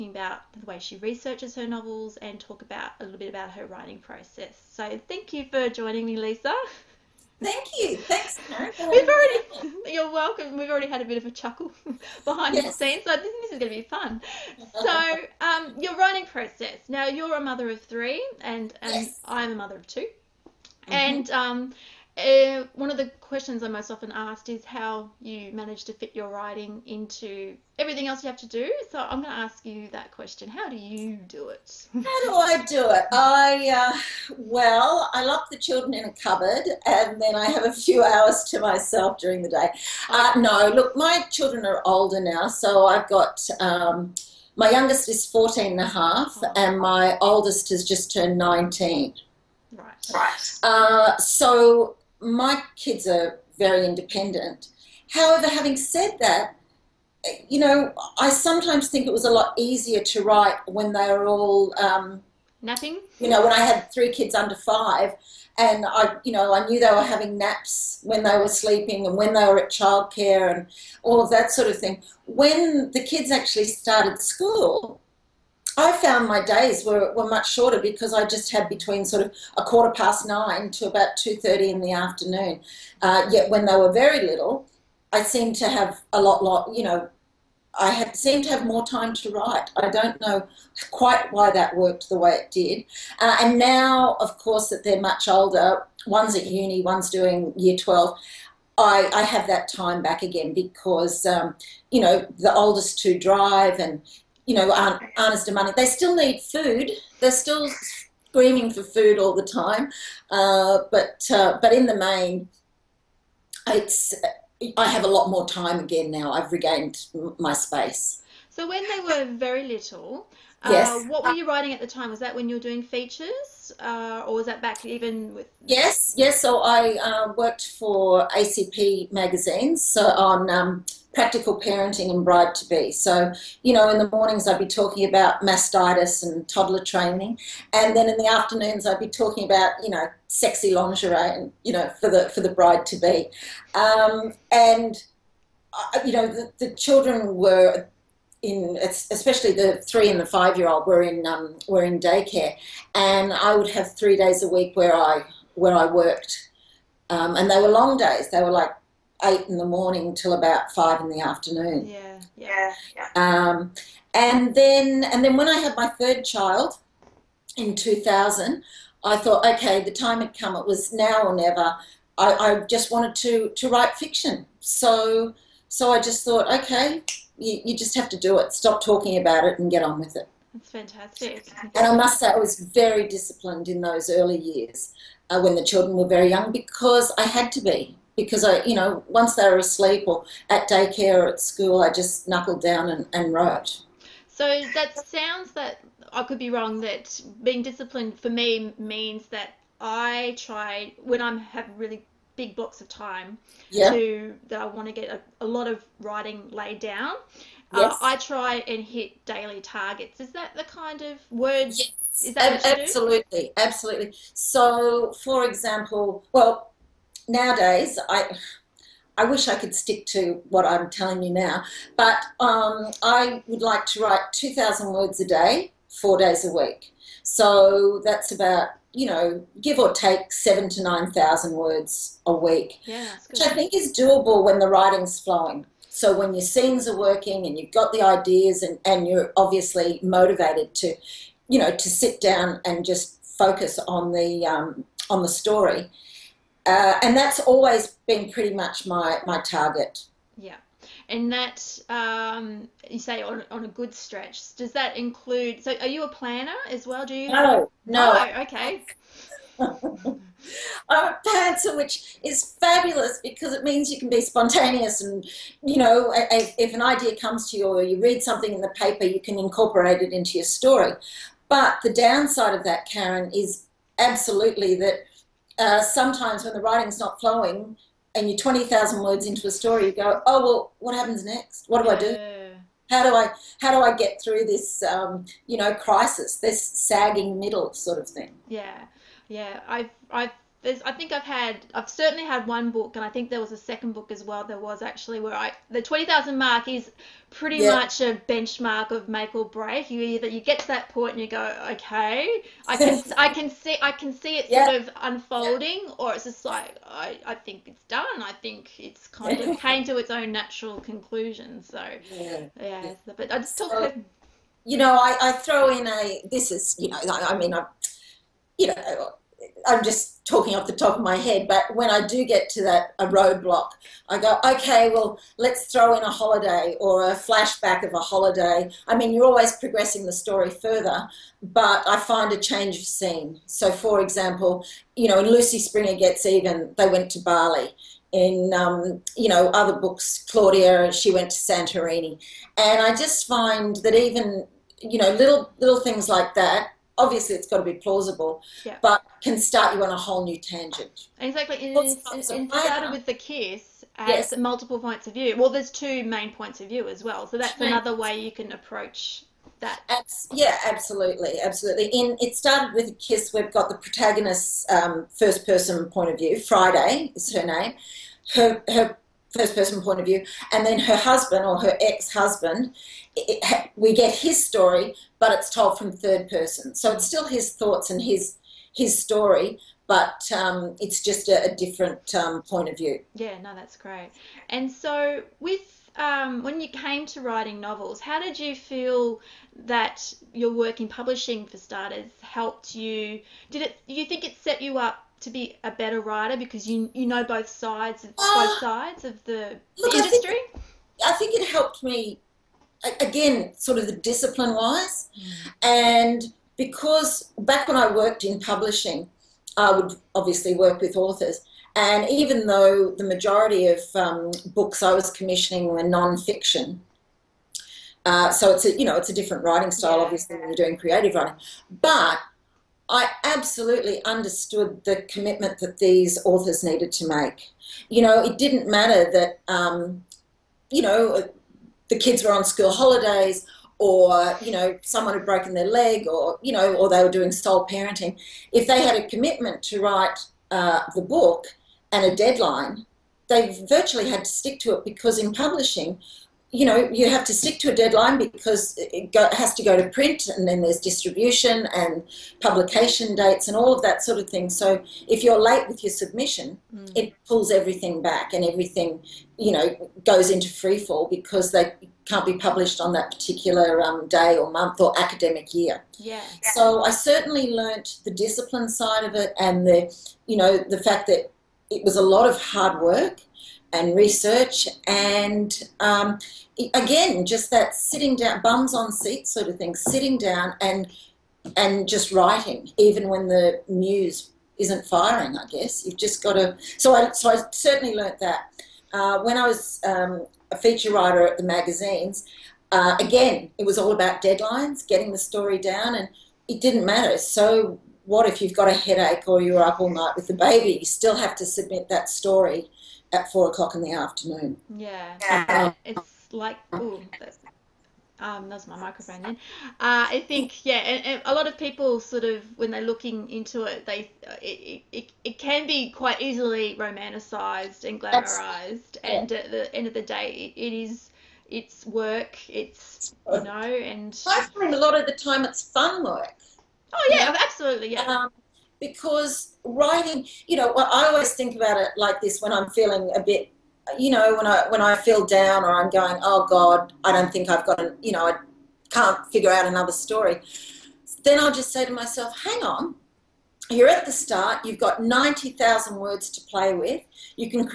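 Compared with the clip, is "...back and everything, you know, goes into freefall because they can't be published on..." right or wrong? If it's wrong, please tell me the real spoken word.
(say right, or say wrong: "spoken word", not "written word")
right.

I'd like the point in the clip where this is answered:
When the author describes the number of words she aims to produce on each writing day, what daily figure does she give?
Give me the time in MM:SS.
03:44.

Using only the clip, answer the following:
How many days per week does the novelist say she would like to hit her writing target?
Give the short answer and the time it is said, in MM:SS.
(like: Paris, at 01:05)
4, at 03:45.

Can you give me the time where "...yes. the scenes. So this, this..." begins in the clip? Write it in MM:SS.
00:12.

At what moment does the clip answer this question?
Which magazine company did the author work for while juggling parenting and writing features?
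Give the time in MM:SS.
02:08.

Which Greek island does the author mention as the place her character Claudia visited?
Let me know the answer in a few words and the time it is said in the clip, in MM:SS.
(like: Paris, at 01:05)
Santorini, at 05:41.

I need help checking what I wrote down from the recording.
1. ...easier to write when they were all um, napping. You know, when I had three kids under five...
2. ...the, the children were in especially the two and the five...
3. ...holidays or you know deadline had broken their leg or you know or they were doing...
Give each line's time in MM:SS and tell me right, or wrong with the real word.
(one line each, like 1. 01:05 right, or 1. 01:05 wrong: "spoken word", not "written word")
1. 00:59 right
2. 02:26 wrong: "three", not "two"
3. 07:12 wrong: "someone", not "deadline".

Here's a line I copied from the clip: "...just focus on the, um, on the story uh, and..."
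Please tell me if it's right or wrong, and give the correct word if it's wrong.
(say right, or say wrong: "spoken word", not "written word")
right.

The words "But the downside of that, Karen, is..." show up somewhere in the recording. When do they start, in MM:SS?
04:31.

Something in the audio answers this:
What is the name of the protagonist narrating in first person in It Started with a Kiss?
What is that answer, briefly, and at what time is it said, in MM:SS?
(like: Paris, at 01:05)
Friday, at 06:06.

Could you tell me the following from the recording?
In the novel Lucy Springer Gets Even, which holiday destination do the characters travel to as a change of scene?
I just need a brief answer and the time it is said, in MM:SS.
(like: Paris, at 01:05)
Bali, at 05:37.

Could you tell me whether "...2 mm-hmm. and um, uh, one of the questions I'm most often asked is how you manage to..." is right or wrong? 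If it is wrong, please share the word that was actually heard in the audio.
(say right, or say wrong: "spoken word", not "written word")
right.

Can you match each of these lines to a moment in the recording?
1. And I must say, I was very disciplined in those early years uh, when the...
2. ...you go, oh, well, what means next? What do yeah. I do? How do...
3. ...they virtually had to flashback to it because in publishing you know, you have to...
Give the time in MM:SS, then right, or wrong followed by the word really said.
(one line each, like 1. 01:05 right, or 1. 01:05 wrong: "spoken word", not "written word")
1. 03:01 right
2. 04:39 wrong: "happens", not "means"
3. 07:23 wrong: "stick", not "flashback".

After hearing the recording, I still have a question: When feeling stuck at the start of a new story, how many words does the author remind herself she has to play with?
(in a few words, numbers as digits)
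90,000.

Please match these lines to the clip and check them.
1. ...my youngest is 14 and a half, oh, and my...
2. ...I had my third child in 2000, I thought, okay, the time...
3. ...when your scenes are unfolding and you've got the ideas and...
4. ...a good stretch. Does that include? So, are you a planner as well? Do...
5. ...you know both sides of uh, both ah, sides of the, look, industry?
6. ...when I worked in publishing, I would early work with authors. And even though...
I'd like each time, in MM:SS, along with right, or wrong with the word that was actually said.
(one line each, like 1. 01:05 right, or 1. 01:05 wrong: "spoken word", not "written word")
1. 00:44 right
2. 02:45 right
3. 03:56 wrong: "working", not "unfolding"
4. 04:13 right
5. 06:36 right
6. 06:47 wrong: "obviously", not "early".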